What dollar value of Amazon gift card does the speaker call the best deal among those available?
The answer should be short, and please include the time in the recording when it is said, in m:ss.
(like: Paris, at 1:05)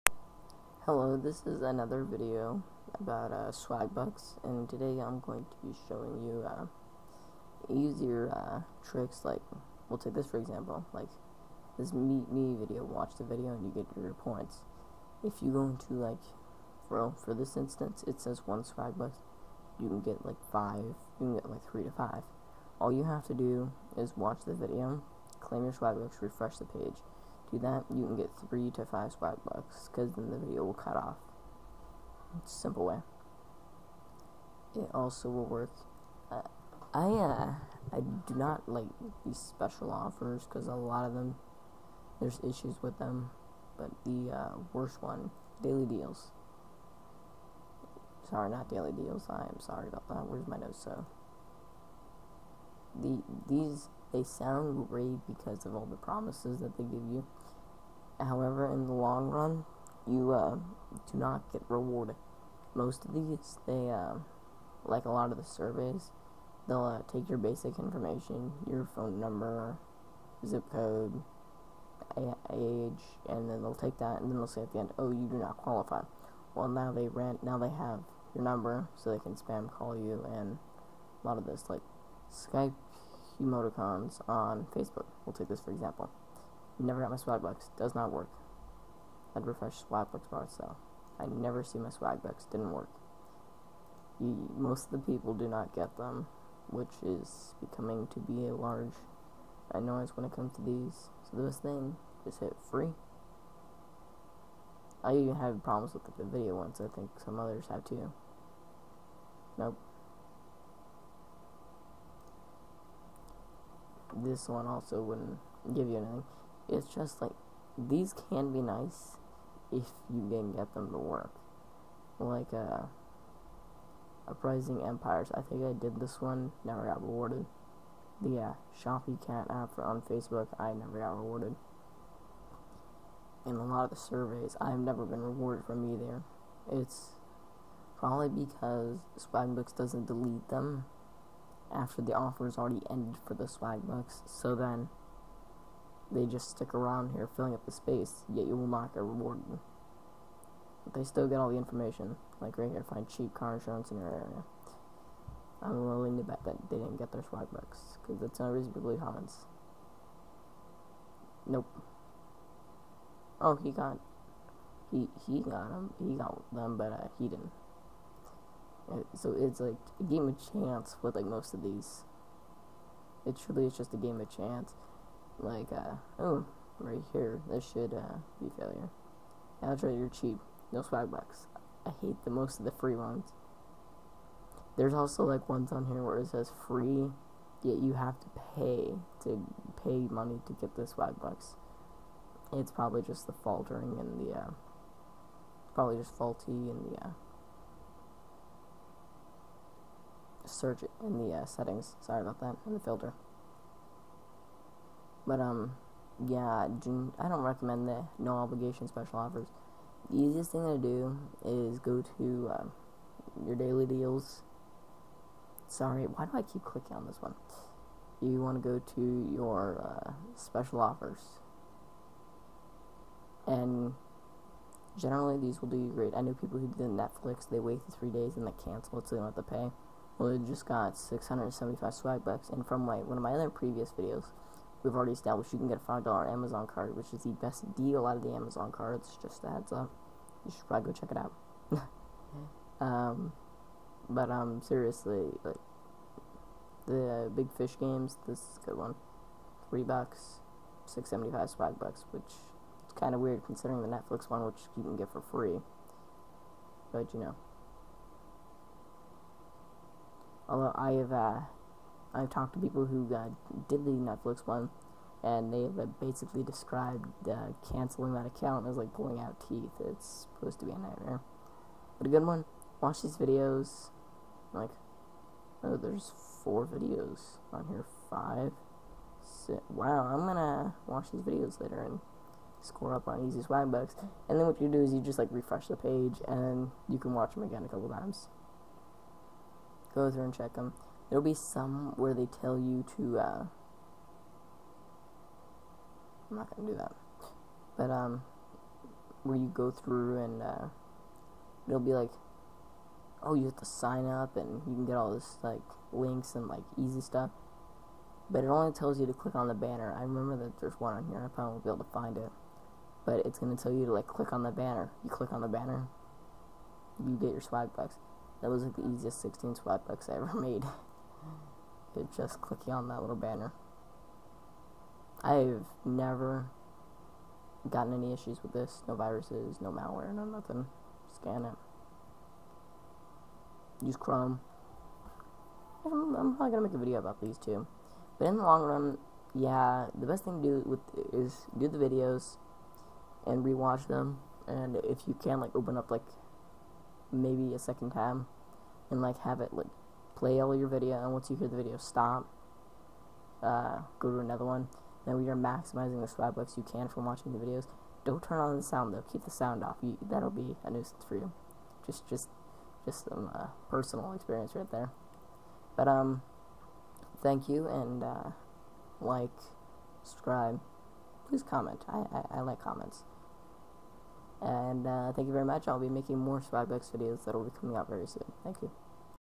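$5, at 3:55.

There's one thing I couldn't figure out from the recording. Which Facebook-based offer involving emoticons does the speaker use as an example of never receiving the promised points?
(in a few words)
Skype emoticons.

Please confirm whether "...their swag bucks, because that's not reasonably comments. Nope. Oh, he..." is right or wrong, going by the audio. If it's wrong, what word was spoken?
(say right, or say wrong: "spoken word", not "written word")
right.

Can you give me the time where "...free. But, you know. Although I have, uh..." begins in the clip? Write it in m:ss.
4:15.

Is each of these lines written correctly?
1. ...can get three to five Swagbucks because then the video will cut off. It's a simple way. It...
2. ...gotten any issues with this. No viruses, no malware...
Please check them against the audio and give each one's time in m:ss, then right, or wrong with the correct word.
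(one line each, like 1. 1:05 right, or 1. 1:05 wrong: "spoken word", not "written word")
1. 0:28 right
2. 5:27 right.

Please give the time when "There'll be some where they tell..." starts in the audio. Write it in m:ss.
4:51.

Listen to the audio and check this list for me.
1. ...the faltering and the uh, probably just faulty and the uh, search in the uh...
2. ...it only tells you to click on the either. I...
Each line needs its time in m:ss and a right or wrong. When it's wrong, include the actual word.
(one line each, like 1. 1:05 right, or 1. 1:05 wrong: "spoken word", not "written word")
1. 3:13 right
2. 5:08 wrong: "banner", not "either".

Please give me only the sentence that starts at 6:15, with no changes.
I'll be making more Swagbucks videos that will be coming out very soon.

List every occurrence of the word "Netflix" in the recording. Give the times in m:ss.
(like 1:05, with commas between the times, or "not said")
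3:46, 4:13, 4:23.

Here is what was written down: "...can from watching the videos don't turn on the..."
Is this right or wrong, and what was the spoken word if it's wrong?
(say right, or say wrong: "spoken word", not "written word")
right.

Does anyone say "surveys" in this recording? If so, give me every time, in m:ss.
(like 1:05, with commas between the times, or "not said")
1:05, 2:13.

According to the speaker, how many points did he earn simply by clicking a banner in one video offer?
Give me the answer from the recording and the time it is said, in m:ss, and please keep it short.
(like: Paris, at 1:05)
16, at 5:19.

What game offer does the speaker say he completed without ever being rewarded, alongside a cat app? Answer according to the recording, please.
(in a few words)
Uprising Empires.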